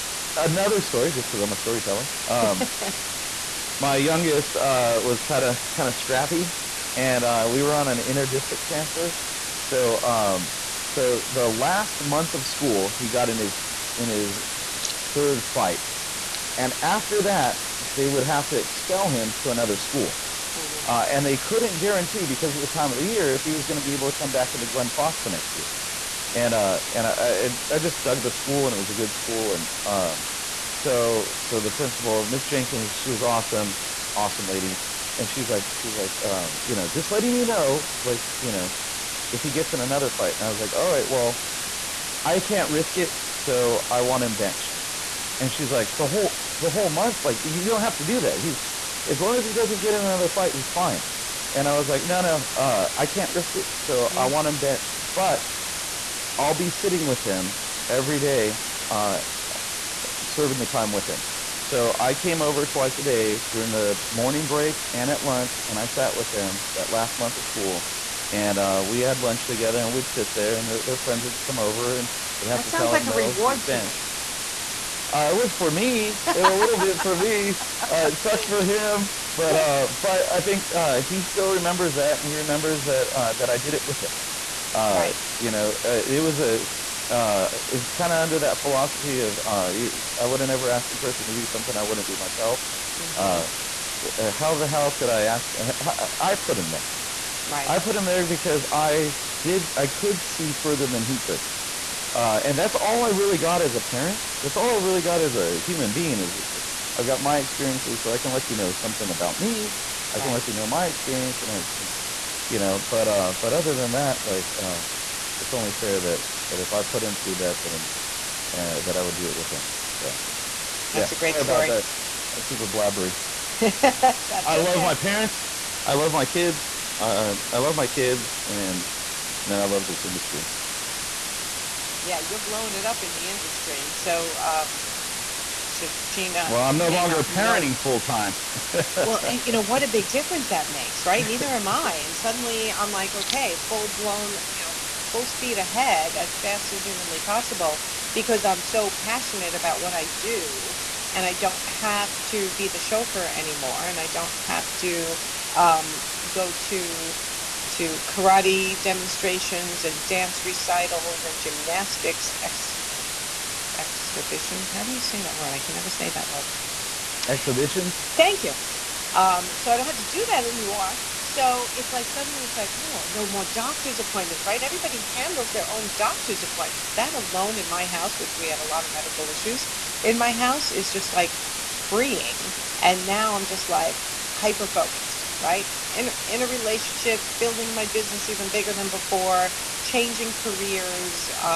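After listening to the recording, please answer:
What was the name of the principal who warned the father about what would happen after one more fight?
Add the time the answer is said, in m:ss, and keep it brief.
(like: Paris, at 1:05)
Miss Jenkins, at 0:32.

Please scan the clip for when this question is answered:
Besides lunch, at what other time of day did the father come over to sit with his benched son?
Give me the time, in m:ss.
1:04.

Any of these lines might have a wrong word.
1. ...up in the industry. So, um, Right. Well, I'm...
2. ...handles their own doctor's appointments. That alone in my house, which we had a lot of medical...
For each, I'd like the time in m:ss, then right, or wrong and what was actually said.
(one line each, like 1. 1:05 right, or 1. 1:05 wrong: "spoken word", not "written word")
1. 2:12 wrong: "Shachina", not "Right"
2. 2:55 right.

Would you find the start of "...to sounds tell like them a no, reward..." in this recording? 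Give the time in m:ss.
1:12.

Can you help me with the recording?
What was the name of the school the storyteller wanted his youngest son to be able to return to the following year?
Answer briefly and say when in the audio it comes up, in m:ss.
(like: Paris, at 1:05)
Glen Foss, at 0:24.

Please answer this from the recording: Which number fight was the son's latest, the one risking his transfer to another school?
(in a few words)
third.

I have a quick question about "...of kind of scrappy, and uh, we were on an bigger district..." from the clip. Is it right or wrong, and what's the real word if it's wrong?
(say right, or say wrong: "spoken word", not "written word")
wrong: "inter", not "bigger".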